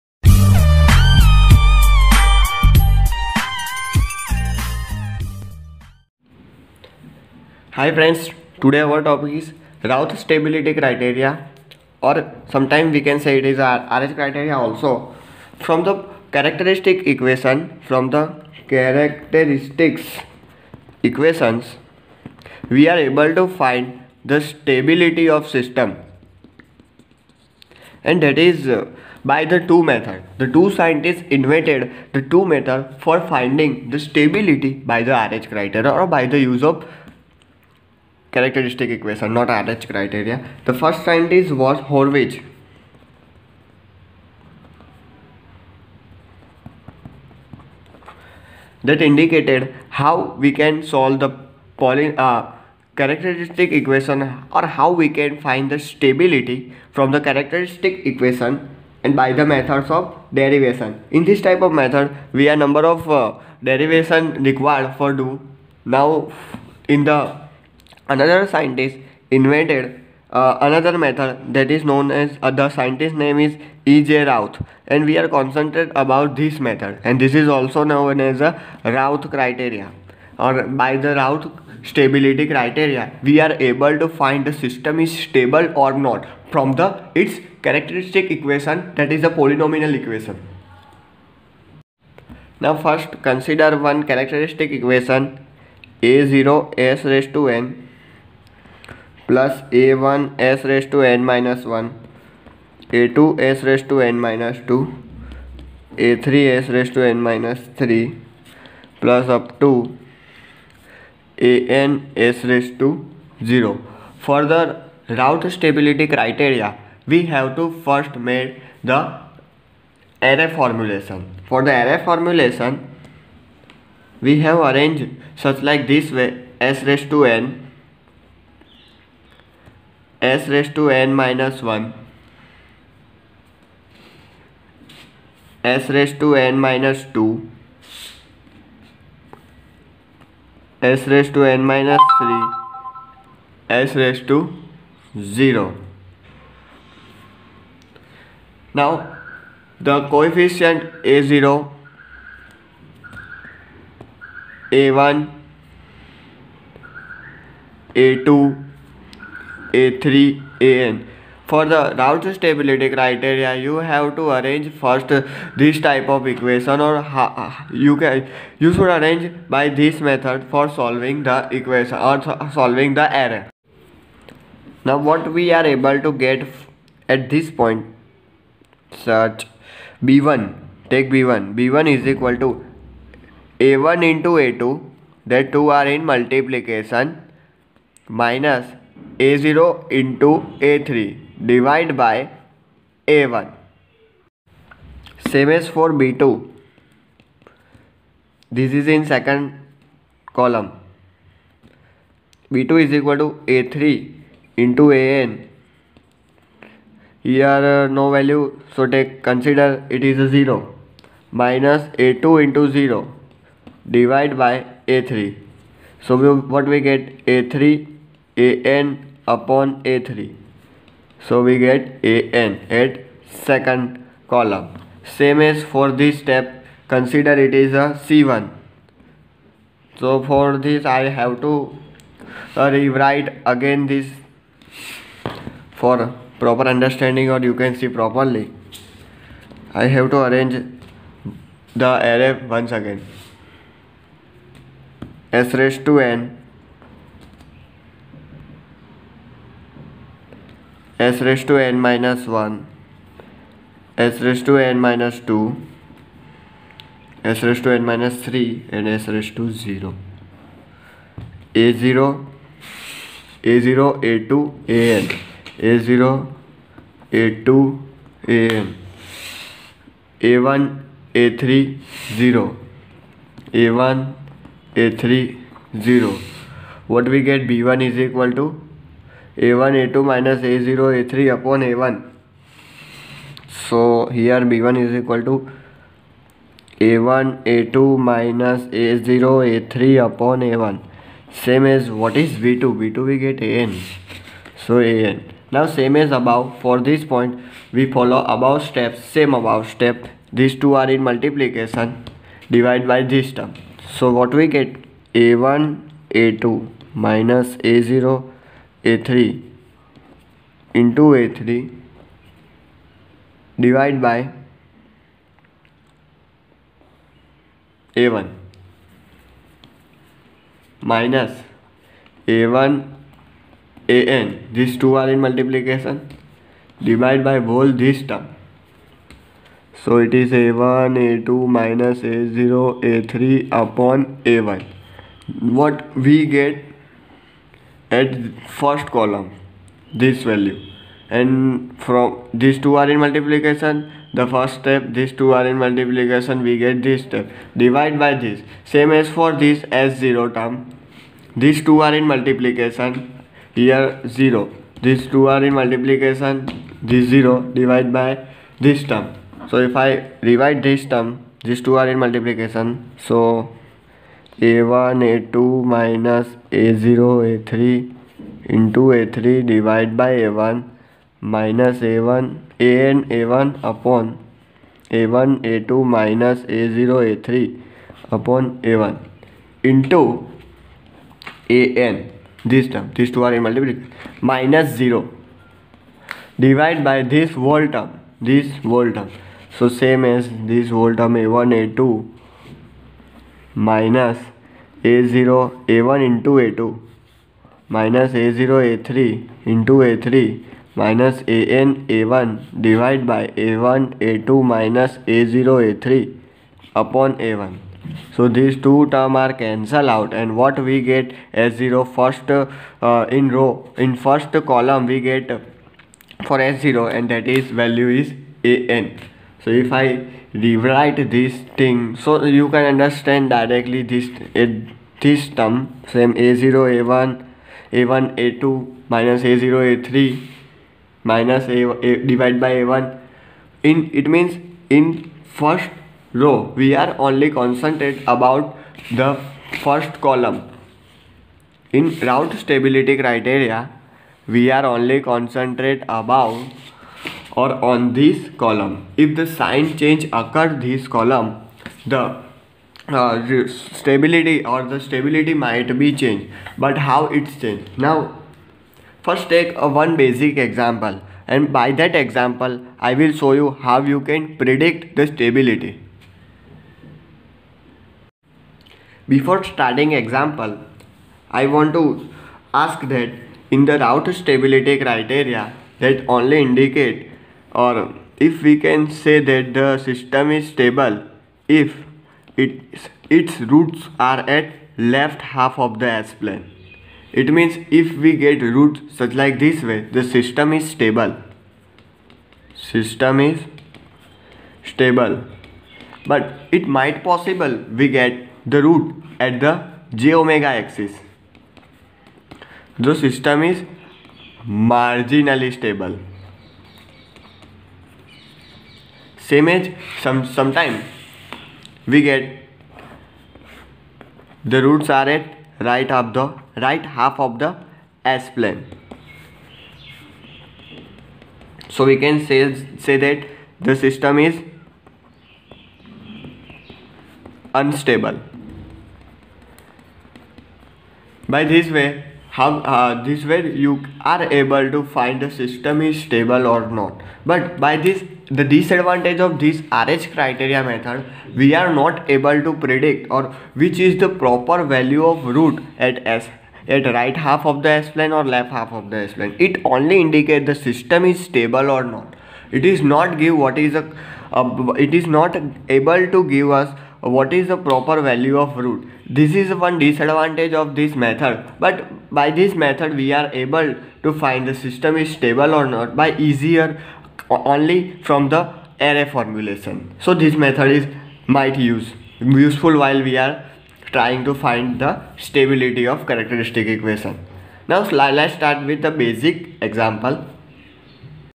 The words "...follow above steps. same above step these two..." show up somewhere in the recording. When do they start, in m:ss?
4:57.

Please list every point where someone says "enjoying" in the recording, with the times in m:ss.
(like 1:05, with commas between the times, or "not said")
not said.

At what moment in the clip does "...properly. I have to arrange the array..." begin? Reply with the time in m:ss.
3:57.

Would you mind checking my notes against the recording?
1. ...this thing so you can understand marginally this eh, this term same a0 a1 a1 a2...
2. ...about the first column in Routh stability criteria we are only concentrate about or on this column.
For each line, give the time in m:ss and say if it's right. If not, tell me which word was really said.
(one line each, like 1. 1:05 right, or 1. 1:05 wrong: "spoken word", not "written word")
1. 7:01 wrong: "directly", not "marginally"
2. 7:18 right.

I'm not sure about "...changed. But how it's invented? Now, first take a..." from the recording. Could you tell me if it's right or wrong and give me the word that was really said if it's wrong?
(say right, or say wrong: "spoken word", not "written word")
wrong: "changed", not "invented".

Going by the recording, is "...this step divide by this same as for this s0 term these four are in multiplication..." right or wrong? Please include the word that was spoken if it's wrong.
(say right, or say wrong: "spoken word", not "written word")
wrong: "two", not "four".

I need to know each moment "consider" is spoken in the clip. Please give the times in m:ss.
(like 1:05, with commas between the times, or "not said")
1:33, 3:29, 3:46.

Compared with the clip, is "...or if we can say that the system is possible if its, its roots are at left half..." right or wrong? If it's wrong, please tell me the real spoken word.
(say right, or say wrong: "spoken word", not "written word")
wrong: "stable", not "possible".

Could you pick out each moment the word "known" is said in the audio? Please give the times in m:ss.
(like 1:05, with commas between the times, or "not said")
1:11, 1:17.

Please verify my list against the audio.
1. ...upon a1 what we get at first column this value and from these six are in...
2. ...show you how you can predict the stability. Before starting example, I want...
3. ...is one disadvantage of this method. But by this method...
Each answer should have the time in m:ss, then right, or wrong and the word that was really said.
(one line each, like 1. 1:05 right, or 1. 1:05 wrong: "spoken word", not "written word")
1. 5:33 wrong: "two", not "six"
2. 7:43 right
3. 9:19 right.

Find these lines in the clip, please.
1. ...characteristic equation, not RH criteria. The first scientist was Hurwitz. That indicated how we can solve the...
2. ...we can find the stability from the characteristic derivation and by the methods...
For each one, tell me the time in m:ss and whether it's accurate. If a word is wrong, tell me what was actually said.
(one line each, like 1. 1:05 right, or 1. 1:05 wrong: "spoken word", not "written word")
1. 0:38 right
2. 0:55 wrong: "equation", not "derivation".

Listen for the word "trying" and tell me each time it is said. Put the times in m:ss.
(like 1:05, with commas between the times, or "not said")
9:33.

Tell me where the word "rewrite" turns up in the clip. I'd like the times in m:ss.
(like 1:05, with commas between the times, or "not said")
3:52, 7:00.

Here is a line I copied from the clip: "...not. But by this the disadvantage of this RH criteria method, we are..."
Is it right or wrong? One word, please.
right.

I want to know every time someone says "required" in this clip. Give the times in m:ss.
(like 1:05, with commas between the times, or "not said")
1:04.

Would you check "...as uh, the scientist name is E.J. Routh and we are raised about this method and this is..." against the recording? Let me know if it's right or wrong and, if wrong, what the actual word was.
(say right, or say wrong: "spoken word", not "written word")
wrong: "concentrated", not "raised".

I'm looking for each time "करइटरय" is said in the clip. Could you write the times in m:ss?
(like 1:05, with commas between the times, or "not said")
1:56.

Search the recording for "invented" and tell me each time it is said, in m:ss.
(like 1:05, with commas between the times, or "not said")
0:31, 1:09.